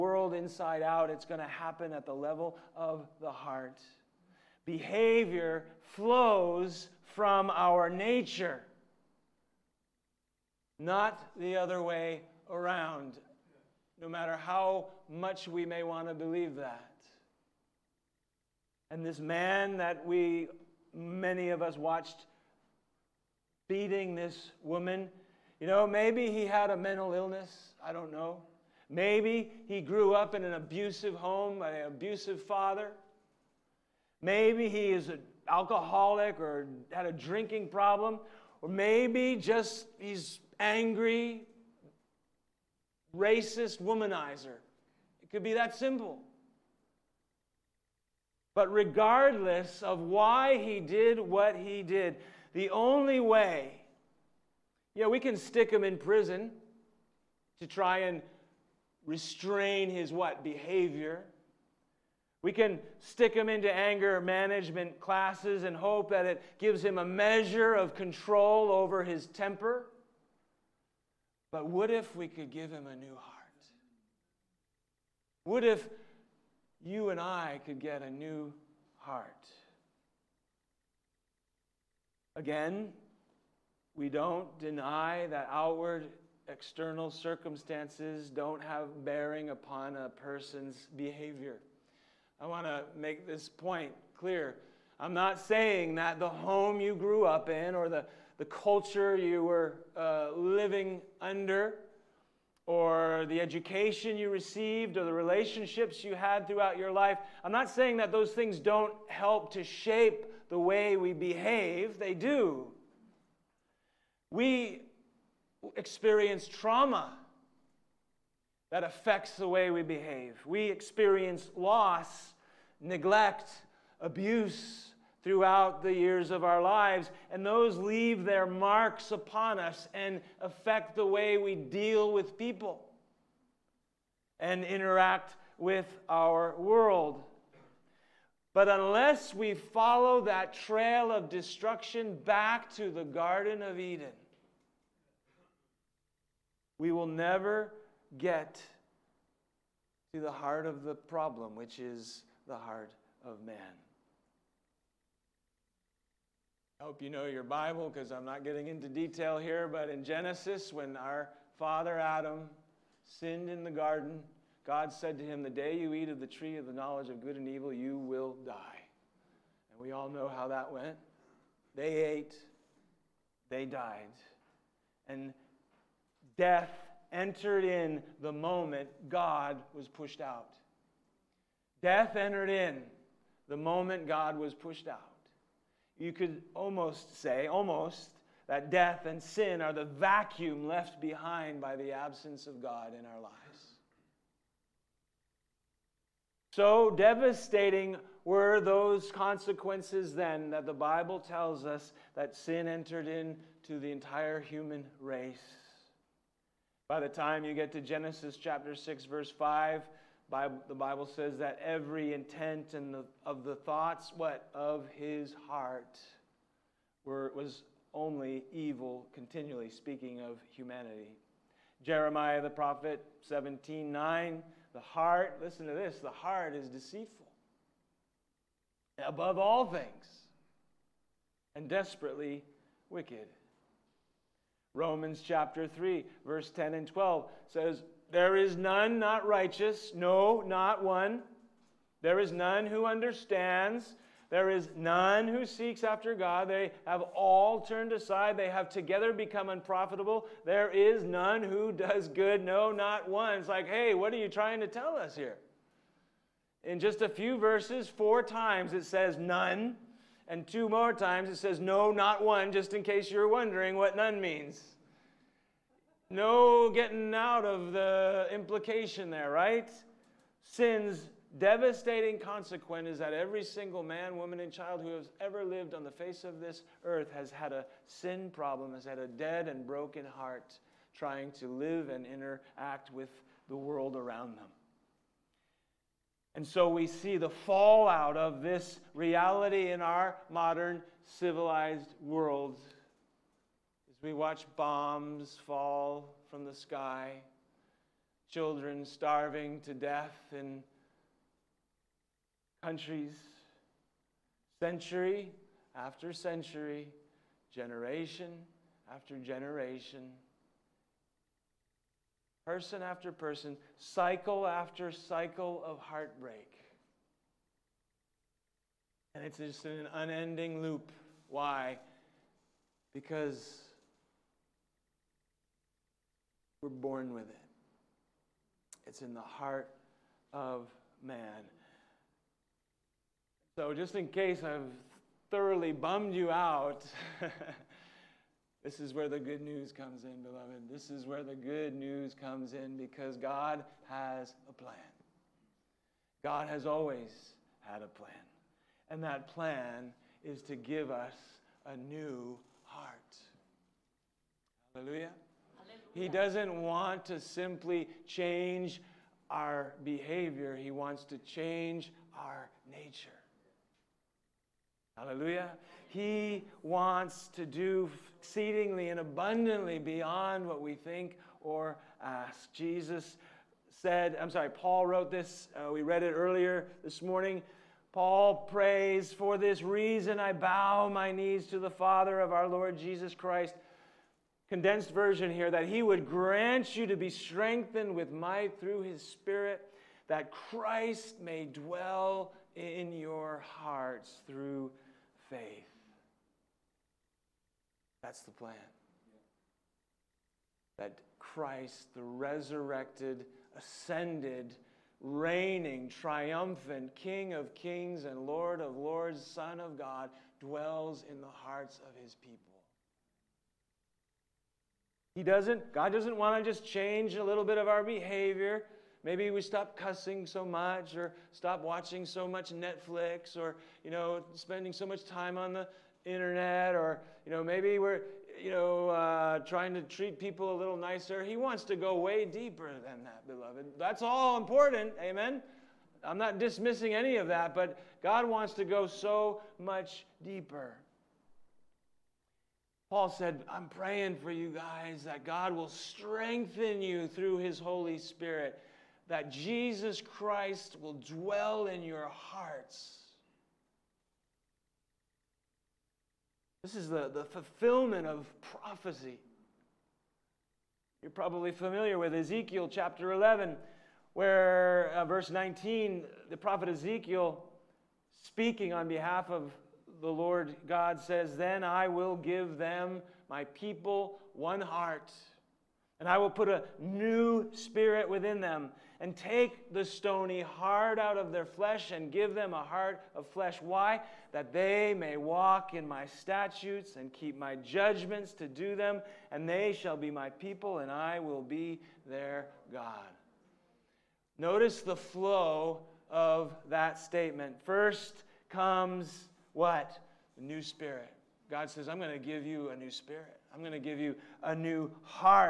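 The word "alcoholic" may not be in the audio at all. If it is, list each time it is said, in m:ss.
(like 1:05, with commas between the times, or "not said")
0:35.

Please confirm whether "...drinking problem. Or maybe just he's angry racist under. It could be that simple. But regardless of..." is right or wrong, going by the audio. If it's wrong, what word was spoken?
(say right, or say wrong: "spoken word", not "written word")
wrong: "womanizer", not "under".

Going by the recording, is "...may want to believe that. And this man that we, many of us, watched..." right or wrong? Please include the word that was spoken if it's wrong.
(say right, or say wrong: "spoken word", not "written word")
right.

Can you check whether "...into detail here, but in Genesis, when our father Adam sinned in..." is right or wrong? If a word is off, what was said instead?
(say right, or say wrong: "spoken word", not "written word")
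right.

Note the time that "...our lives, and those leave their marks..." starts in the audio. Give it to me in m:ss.
2:06.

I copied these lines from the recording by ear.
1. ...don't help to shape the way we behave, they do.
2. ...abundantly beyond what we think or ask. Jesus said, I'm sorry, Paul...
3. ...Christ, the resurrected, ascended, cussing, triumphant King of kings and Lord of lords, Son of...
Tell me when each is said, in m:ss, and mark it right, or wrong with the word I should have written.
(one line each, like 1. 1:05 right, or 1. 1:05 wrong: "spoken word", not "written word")
1. 1:48 right
2. 6:09 right
3. 6:41 wrong: "reigning", not "cussing".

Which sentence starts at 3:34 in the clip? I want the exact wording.
Of his heart were, was only evil, continually speaking of humanity.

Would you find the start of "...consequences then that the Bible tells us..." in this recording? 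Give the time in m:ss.
3:19.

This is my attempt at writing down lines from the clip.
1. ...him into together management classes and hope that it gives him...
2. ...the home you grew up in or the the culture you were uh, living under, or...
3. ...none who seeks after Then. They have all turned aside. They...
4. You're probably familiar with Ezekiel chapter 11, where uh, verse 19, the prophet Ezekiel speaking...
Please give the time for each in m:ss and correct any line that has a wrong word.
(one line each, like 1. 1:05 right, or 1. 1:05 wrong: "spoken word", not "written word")
1. 1:03 wrong: "anger", not "together"
2. 1:36 right
3. 4:04 wrong: "God", not "Then"
4. 7:41 right.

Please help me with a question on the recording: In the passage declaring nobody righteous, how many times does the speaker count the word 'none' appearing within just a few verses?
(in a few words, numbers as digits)
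4.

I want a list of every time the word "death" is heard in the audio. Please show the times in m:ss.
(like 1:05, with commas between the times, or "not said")
2:56, 3:01, 3:08, 4:59.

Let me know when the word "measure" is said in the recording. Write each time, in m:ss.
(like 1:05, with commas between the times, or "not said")
1:07.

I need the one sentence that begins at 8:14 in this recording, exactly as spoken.
Notice the flow of that statement.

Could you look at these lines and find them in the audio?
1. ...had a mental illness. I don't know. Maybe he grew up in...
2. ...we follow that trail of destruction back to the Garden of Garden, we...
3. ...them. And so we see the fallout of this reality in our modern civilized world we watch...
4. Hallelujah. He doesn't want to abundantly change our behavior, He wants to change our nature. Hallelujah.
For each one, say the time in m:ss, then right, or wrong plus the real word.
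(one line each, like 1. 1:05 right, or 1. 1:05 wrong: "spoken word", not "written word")
1. 0:26 right
2. 2:19 wrong: "Eden", not "Garden"
3. 4:44 right
4. 5:54 wrong: "simply", not "abundantly".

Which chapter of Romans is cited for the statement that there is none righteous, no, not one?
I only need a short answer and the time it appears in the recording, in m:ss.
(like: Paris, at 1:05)
Chapter 3, at 3:54.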